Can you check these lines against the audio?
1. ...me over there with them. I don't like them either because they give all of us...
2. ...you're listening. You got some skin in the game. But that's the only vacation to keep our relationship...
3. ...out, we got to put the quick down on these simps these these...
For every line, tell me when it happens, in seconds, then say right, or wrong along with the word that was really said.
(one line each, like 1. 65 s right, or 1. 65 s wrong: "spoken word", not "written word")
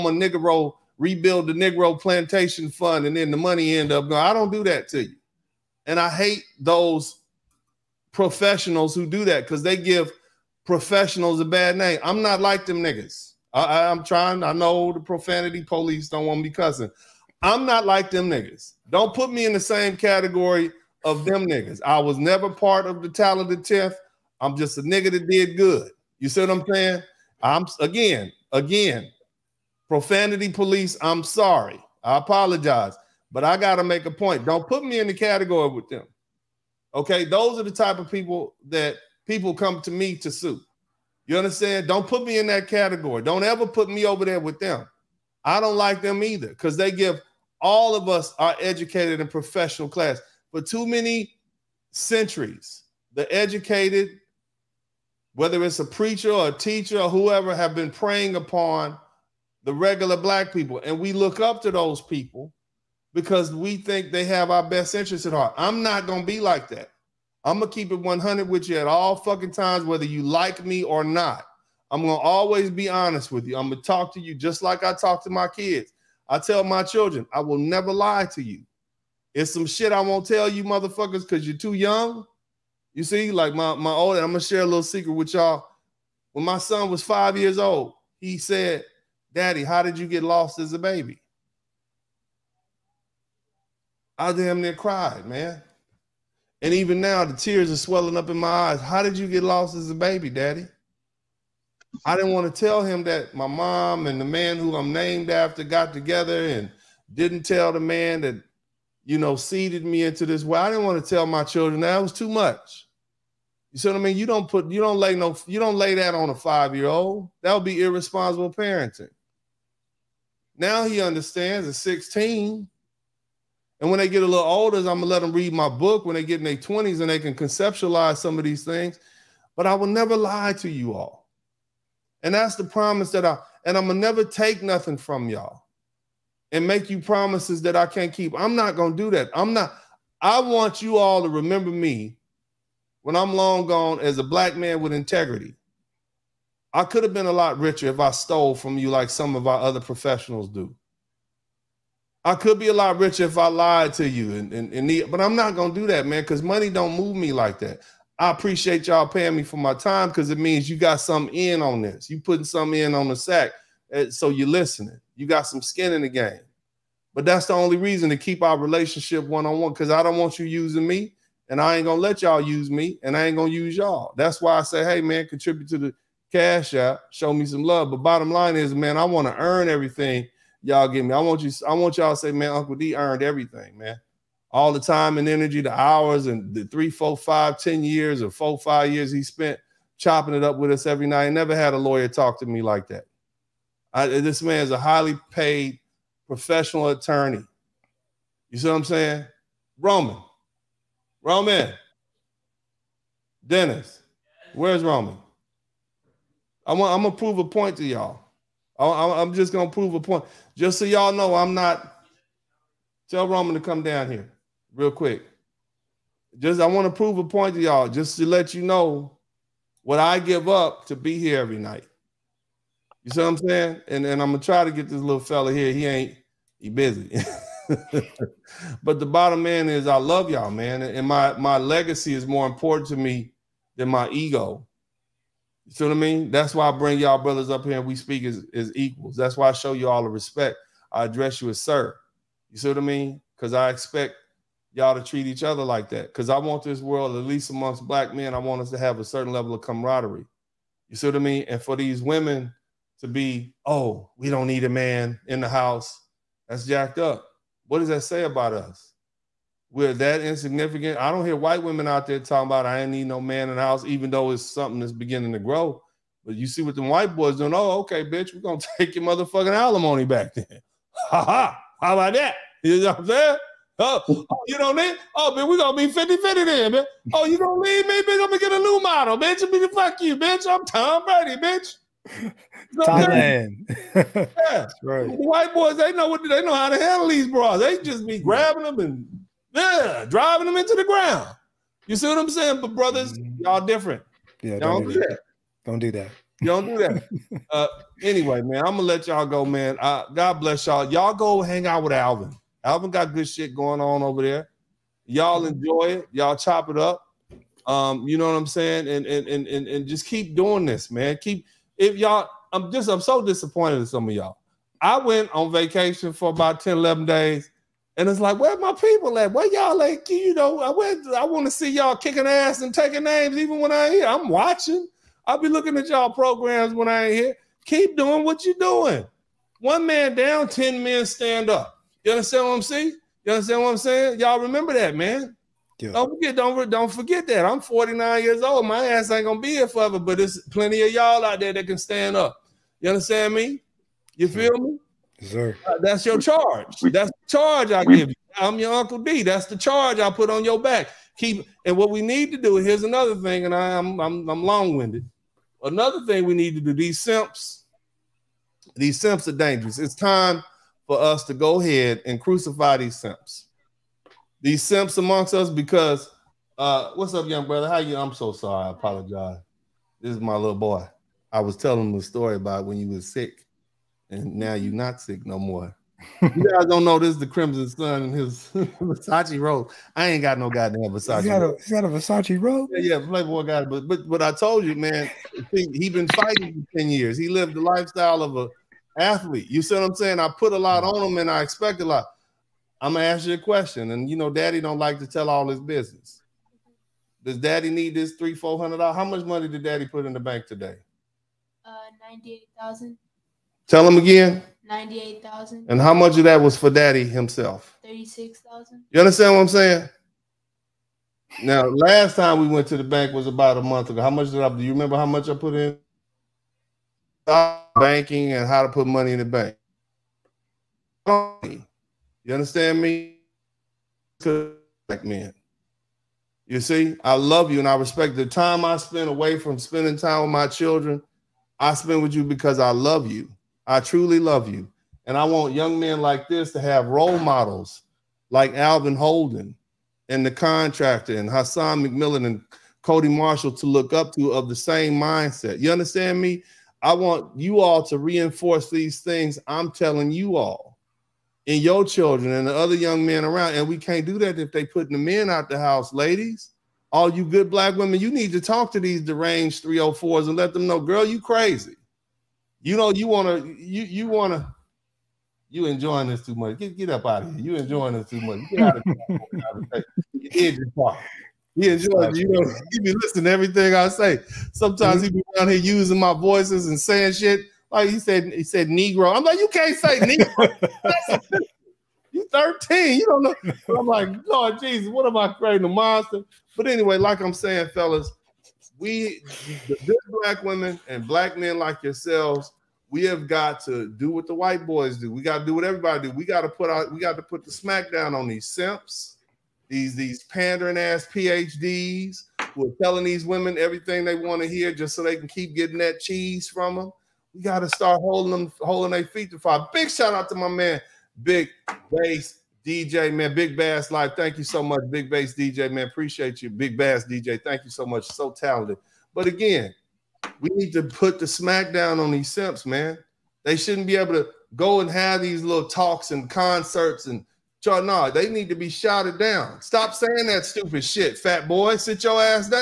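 1. 43 s right
2. 164 s wrong: "reason", not "vacation"
3. 496 s wrong: "smack", not "quick".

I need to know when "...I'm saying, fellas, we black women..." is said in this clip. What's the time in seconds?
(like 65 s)
487 s.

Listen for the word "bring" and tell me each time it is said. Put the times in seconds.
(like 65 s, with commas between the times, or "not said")
236 s.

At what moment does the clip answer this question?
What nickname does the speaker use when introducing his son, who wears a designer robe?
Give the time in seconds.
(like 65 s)
377 s.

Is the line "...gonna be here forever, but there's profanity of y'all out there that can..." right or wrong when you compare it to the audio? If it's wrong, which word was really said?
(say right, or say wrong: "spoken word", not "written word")
wrong: "plenty", not "profanity".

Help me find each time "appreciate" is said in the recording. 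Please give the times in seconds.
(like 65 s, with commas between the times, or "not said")
158 s, 515 s.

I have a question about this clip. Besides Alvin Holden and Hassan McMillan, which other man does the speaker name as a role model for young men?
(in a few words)
Cody Marshall.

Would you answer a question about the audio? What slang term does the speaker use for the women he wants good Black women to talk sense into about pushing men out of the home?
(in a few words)
304s.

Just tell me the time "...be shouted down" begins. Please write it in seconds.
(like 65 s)
528 s.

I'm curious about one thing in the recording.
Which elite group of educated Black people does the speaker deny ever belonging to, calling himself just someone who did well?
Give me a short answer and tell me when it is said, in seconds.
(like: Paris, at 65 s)
Talented 10th, at 23 s.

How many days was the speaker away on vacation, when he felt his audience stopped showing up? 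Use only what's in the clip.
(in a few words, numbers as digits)
10 or 11 days.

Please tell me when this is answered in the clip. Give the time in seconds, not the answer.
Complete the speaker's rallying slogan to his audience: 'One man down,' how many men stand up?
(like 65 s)
330 s.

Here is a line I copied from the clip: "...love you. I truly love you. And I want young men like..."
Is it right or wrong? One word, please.
right.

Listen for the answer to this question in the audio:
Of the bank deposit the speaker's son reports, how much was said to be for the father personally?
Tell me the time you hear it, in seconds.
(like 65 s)
407 s.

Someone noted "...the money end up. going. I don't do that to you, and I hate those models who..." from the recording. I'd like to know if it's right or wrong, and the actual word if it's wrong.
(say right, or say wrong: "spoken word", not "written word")
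wrong: "professionals", not "models".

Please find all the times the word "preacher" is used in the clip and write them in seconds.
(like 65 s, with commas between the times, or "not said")
55 s.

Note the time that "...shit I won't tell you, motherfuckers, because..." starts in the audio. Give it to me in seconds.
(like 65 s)
79 s.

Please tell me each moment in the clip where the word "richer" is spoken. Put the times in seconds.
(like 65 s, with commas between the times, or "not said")
147 s, 152 s.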